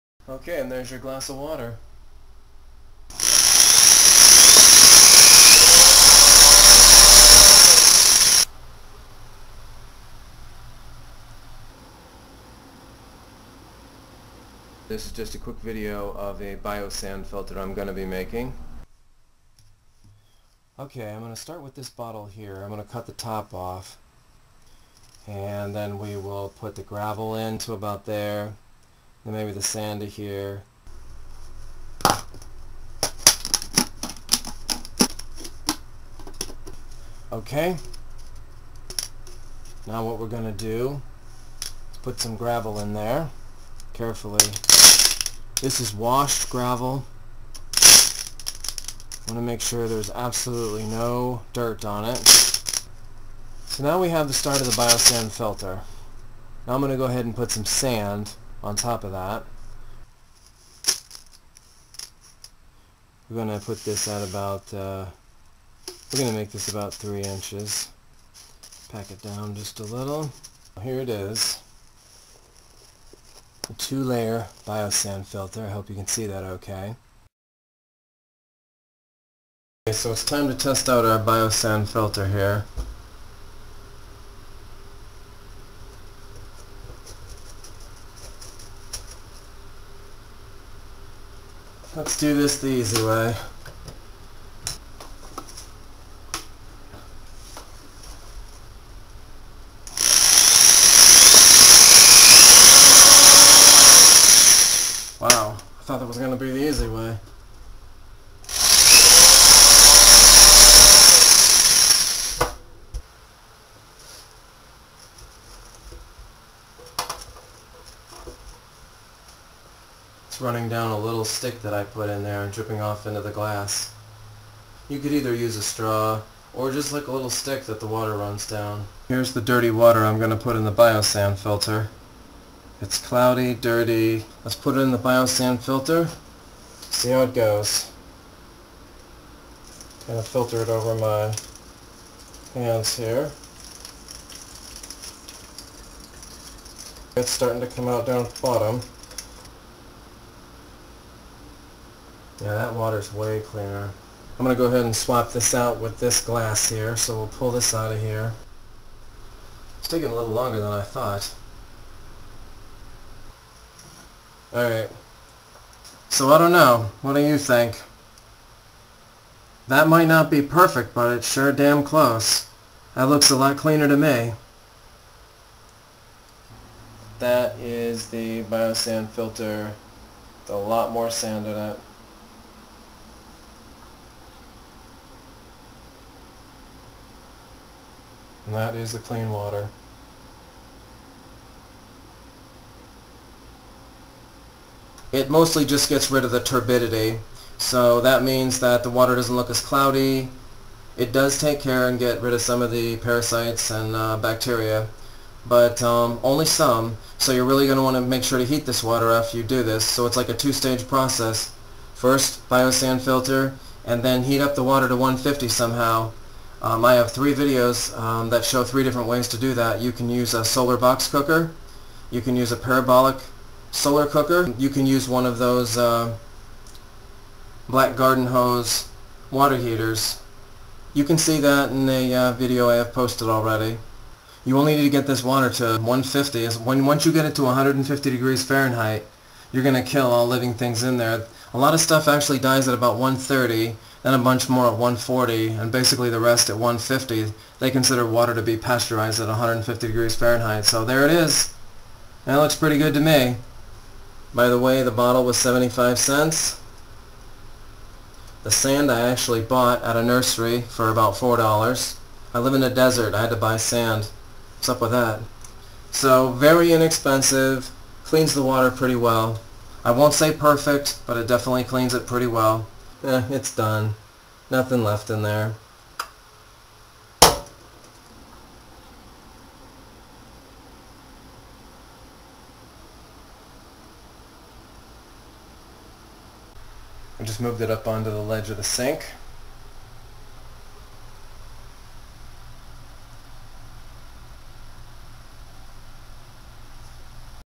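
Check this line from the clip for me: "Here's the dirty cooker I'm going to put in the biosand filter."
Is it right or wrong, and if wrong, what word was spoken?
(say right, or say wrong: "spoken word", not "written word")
wrong: "water", not "cooker".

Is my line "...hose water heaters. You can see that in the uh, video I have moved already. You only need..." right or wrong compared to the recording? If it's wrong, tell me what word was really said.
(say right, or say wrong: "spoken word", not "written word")
wrong: "posted", not "moved".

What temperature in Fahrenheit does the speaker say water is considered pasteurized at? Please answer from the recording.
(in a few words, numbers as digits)
150.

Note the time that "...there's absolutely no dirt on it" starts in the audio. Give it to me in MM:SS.
00:49.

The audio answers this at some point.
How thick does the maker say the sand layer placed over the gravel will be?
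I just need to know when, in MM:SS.
01:06.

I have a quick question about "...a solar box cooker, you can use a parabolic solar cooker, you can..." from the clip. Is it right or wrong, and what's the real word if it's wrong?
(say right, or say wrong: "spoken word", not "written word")
right.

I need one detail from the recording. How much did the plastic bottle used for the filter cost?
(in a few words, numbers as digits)
75 cents.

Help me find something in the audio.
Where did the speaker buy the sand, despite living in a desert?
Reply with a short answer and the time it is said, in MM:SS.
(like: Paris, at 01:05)
a nursery, at 04:19.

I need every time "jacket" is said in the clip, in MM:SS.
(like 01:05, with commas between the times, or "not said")
not said.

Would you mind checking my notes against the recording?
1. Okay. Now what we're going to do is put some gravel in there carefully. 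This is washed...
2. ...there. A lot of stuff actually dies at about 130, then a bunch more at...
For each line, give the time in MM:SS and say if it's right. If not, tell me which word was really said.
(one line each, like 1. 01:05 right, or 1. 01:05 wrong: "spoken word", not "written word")
1. 00:37 right
2. 04:00 right.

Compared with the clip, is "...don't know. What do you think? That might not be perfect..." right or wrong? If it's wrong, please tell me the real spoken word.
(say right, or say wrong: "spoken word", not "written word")
right.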